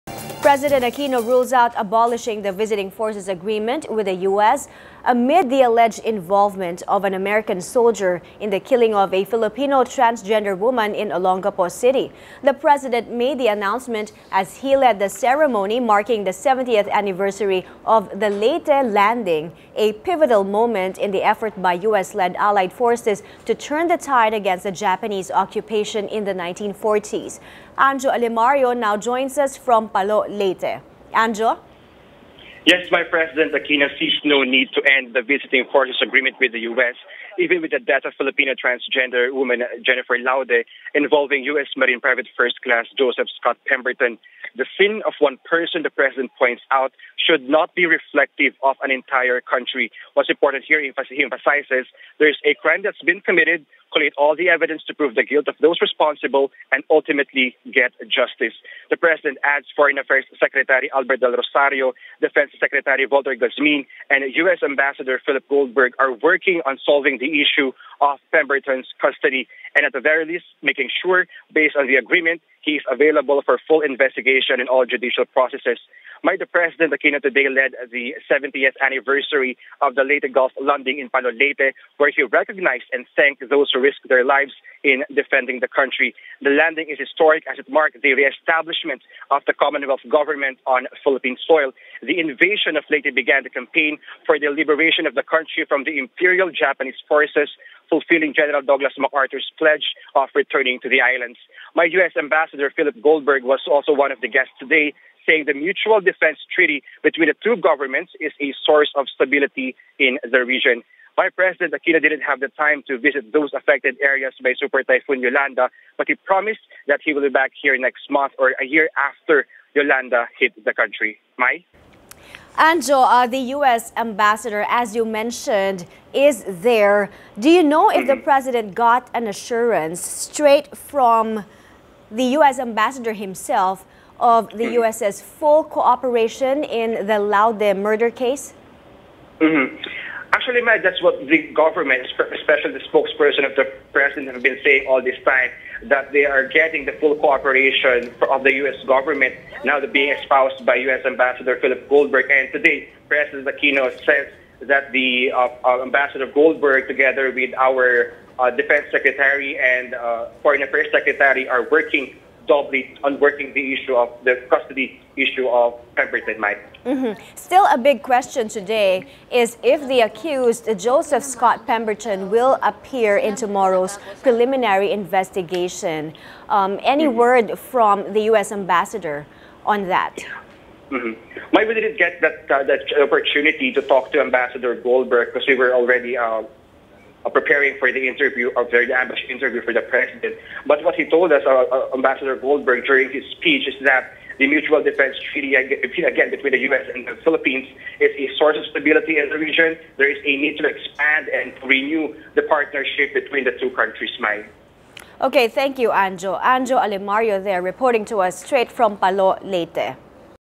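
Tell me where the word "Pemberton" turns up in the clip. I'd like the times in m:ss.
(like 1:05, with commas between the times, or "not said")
0:43, 1:08, 2:45, 2:51.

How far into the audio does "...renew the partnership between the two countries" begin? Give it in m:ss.
3:21.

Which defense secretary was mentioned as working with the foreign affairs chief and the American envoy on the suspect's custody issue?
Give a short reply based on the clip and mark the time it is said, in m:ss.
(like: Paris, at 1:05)
Walter Gazmin, at 1:03.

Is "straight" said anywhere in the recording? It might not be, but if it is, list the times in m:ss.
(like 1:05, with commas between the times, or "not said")
2:10, 3:28.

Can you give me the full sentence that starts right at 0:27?
Anjo Alimario now joins us from Palo, Leyte.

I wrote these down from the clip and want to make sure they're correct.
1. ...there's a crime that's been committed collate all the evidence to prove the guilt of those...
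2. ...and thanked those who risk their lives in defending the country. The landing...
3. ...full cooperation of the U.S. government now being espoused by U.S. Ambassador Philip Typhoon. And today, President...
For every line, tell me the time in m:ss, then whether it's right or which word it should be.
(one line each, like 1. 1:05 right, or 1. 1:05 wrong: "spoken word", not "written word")
1. 0:52 right
2. 1:22 right
3. 2:26 wrong: "Goldberg", not "Typhoon".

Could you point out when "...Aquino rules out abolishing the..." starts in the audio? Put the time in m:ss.
0:00.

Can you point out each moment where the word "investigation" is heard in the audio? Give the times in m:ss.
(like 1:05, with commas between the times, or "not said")
1:13, 2:55.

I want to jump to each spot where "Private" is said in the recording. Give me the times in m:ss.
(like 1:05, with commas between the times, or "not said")
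0:41.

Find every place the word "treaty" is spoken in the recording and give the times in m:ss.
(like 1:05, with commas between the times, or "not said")
1:46, 3:15.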